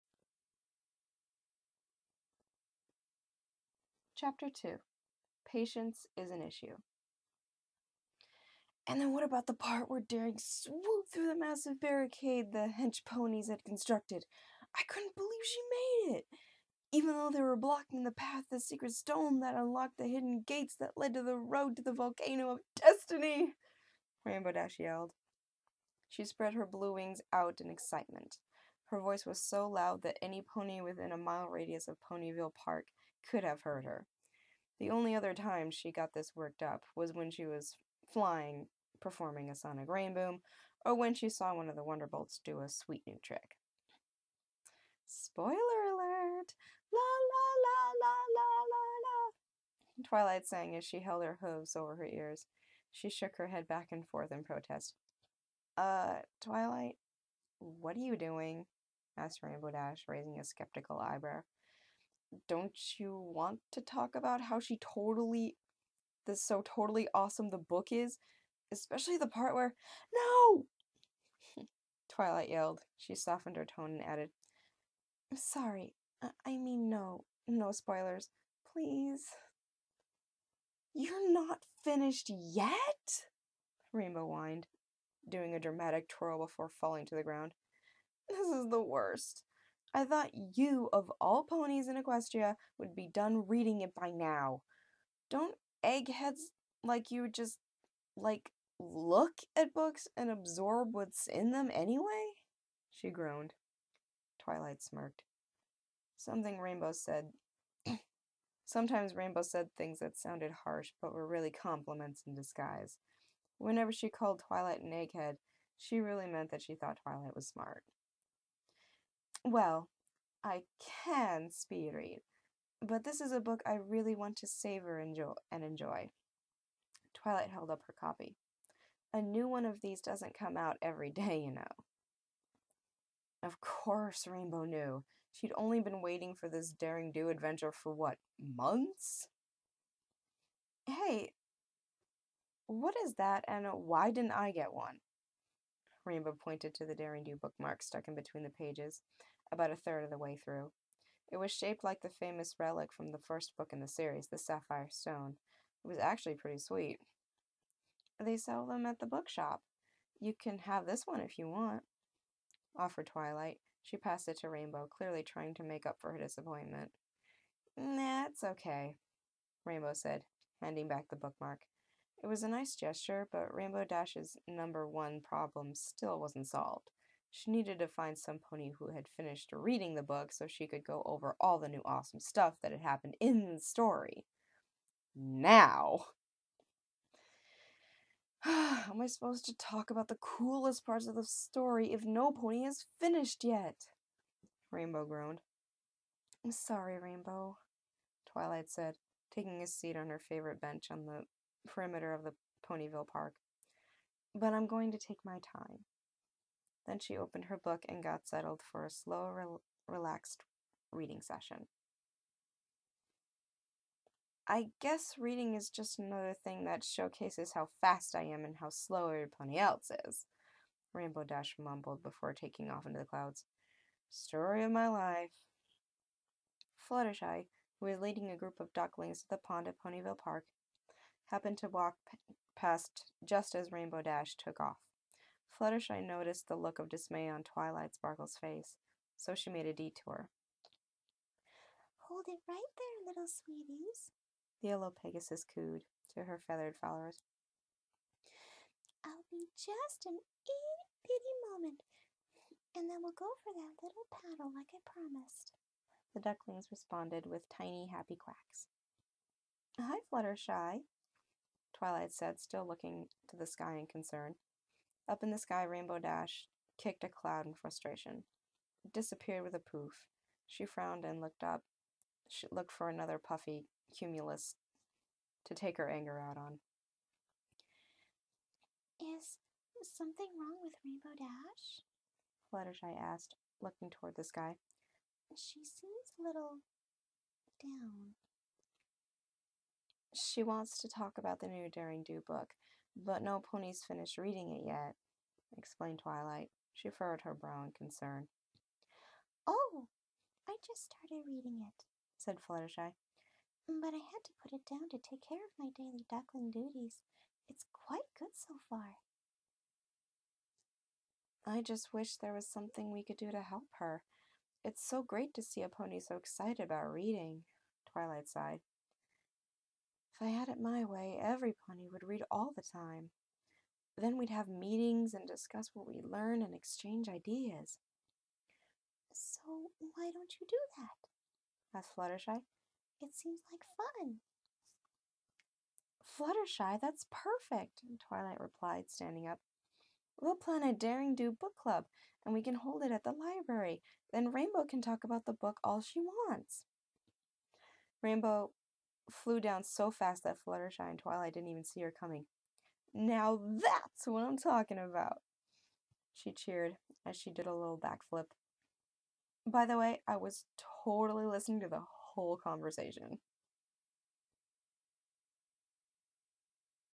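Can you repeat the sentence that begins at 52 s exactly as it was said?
She shook her head back and forth in protest.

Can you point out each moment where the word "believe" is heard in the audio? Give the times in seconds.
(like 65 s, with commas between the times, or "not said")
15 s.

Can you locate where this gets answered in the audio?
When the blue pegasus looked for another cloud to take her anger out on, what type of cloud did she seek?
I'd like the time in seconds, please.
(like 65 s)
273 s.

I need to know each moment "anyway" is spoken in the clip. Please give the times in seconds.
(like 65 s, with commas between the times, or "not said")
101 s.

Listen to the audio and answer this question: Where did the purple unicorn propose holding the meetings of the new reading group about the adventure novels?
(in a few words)
the library.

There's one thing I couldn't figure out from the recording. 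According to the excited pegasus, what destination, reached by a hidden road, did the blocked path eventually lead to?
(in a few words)
the volcano of destiny.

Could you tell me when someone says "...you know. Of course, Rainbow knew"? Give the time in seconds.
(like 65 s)
131 s.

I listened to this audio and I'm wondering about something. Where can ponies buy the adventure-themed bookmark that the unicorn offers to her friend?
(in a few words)
the bookshop.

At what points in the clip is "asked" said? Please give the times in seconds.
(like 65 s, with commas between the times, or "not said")
59 s, 282 s, 331 s.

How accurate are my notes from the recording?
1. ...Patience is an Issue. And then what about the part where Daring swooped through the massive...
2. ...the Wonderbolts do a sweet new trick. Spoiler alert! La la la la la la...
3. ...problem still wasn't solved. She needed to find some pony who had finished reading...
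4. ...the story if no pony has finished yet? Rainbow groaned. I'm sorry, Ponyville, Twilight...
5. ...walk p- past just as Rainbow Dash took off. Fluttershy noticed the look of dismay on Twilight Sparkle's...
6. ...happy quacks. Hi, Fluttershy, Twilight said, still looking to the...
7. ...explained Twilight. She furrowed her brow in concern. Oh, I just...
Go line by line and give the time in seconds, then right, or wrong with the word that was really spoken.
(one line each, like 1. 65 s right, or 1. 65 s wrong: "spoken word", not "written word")
1. 5 s right
2. 41 s right
3. 175 s right
4. 191 s wrong: "Rainbow", not "Ponyville"
5. 231 s right
6. 257 s right
7. 295 s right.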